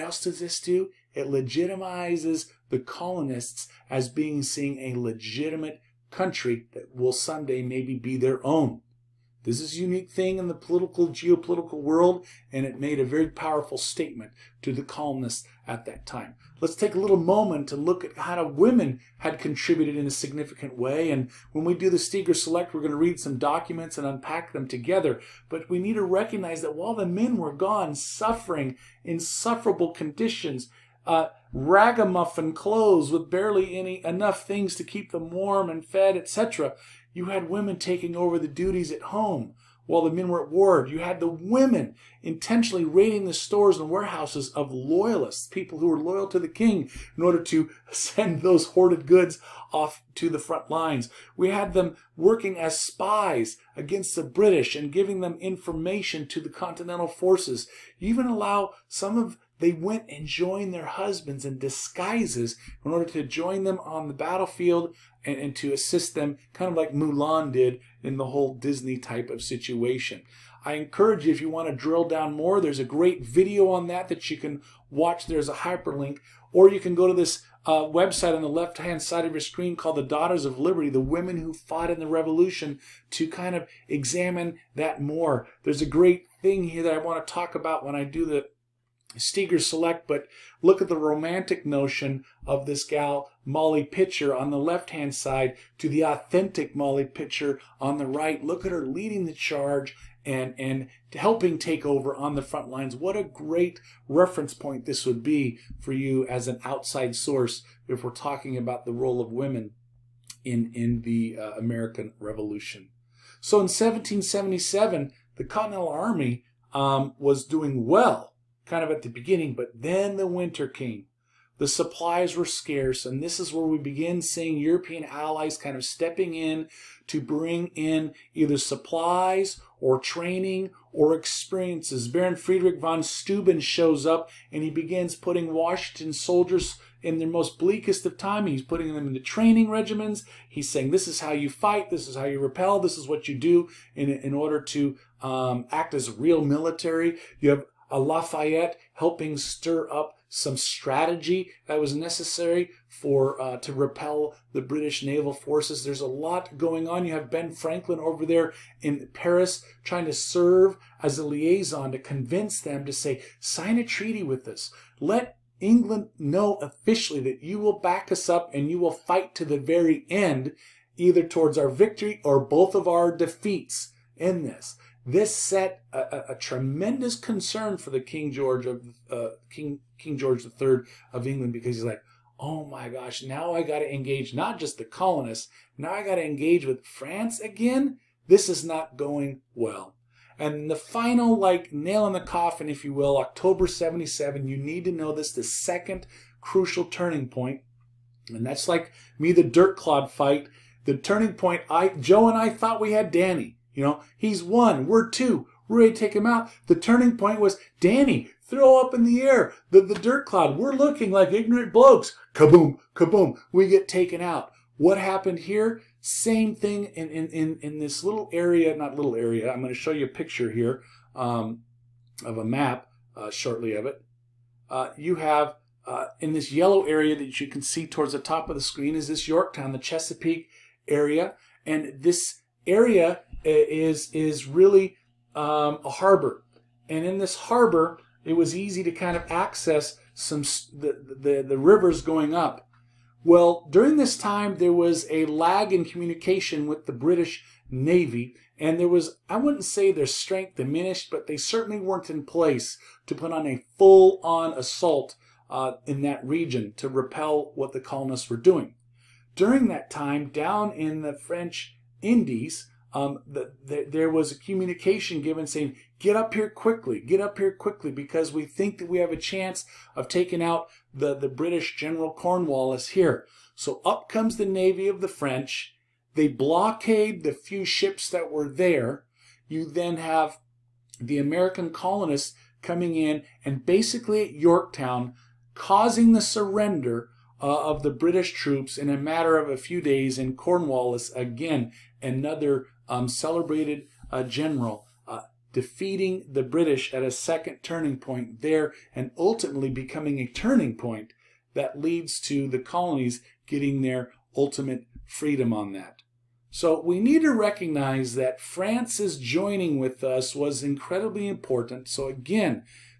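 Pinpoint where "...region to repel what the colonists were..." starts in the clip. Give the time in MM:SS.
04:16.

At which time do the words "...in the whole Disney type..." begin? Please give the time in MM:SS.
01:08.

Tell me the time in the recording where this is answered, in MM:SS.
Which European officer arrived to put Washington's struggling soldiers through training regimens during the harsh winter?
02:12.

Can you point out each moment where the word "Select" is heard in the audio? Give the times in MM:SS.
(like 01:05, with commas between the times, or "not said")
00:22, 01:29.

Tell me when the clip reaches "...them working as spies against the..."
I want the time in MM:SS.
00:51.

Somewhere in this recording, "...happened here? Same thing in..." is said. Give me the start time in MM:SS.
03:34.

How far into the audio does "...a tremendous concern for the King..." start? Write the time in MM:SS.
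02:56.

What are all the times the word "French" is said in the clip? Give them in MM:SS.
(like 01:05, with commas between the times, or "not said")
04:21, 04:35.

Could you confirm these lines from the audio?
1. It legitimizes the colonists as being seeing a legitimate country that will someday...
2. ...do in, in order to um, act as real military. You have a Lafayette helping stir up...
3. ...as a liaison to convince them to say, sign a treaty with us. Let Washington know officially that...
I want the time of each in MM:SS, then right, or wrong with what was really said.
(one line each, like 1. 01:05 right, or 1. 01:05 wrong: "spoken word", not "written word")
1. 00:01 right
2. 02:23 right
3. 02:41 wrong: "England", not "Washington".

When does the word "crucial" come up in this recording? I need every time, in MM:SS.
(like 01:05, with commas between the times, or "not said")
03:16.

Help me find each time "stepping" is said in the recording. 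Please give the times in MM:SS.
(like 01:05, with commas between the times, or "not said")
02:05.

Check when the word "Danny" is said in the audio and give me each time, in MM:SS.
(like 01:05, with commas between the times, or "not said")
03:23, 03:27.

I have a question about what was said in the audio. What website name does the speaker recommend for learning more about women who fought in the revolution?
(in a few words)
The Daughters of Liberty.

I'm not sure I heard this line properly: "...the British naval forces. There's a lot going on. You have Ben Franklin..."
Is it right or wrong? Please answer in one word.
right.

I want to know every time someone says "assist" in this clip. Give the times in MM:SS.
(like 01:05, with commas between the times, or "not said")
01:05.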